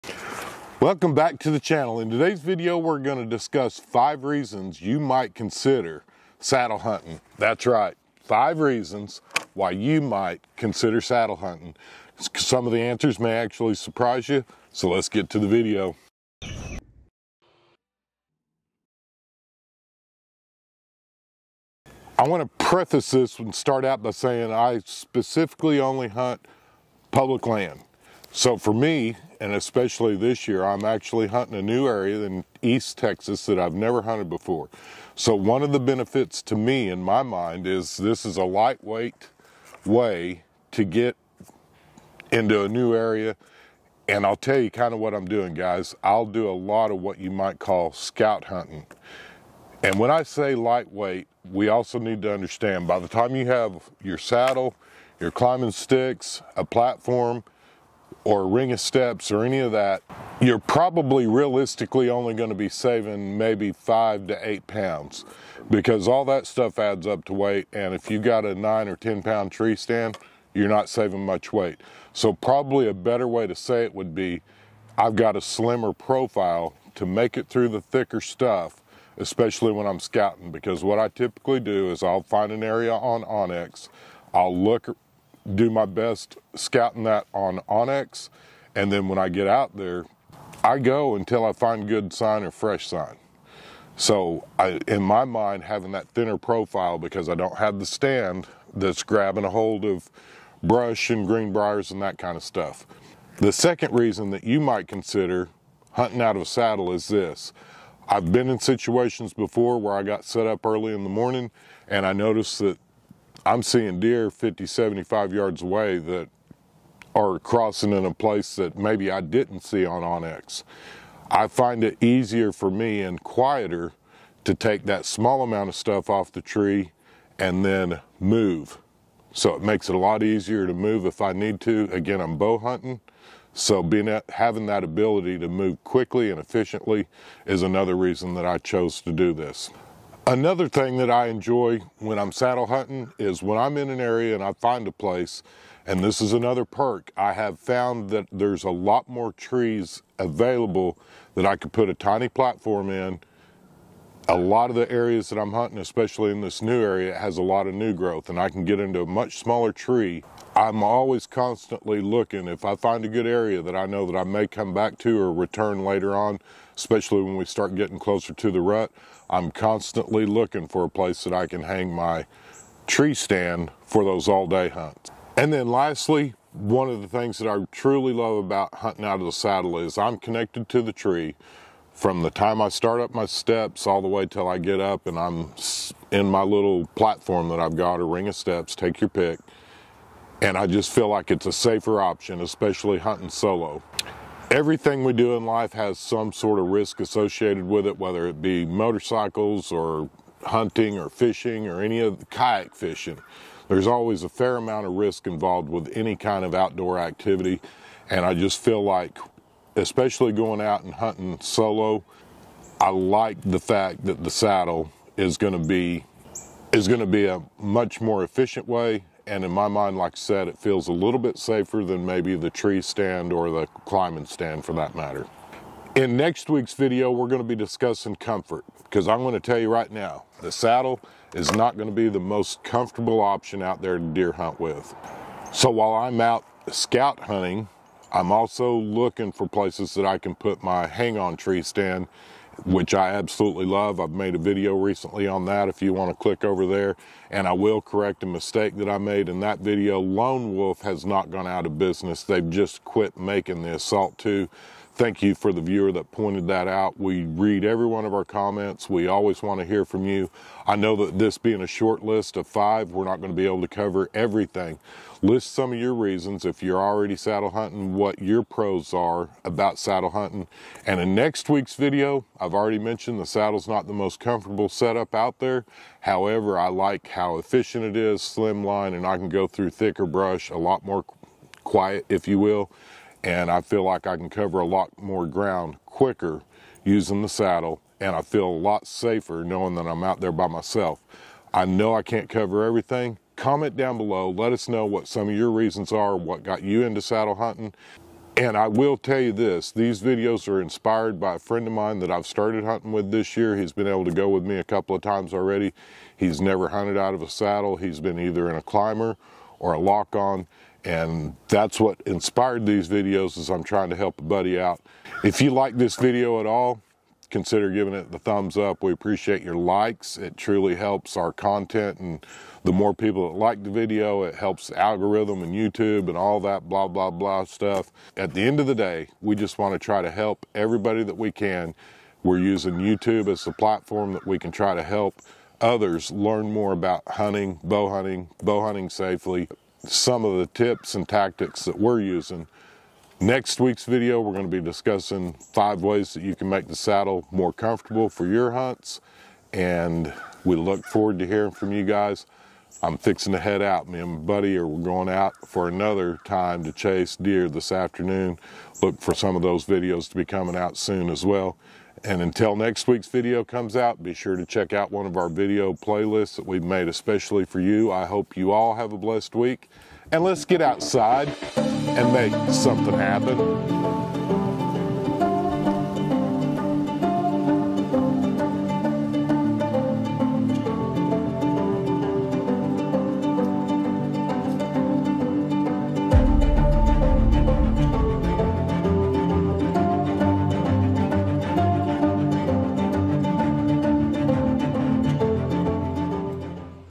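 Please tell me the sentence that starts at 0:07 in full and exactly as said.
That's right, five reasons why you might consider saddle hunting.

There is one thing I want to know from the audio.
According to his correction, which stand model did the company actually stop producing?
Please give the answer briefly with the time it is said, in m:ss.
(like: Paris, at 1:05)
Assault 2, at 4:13.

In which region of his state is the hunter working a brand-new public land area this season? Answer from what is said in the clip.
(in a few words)
East Texas.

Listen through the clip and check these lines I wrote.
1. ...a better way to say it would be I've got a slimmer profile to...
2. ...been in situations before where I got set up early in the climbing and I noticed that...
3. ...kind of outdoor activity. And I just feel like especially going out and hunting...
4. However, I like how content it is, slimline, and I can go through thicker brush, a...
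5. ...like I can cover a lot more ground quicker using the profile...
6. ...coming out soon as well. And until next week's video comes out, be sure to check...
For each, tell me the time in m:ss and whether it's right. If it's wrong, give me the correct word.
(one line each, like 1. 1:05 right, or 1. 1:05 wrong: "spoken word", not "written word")
1. 1:12 right
2. 1:48 wrong: "morning", not "climbing"
3. 3:26 right
4. 4:36 wrong: "efficient", not "content"
5. 4:43 wrong: "saddle", not "profile"
6. 6:00 right.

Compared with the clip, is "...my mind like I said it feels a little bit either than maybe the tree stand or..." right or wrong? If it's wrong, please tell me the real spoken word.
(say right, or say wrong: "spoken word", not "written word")
wrong: "safer", not "either".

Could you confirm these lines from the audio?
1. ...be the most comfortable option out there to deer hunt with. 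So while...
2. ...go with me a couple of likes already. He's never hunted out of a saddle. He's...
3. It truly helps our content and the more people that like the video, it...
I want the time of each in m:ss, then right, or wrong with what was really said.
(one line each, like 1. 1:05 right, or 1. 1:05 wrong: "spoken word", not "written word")
1. 3:51 right
2. 5:04 wrong: "times", not "likes"
3. 5:20 right.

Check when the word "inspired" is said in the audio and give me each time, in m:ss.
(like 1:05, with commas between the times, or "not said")
5:00, 5:12.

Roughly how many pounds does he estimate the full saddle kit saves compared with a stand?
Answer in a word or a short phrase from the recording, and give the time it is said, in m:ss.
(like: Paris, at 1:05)
5 to 8 pounds, at 1:03.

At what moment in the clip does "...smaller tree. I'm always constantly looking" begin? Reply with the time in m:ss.
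2:39.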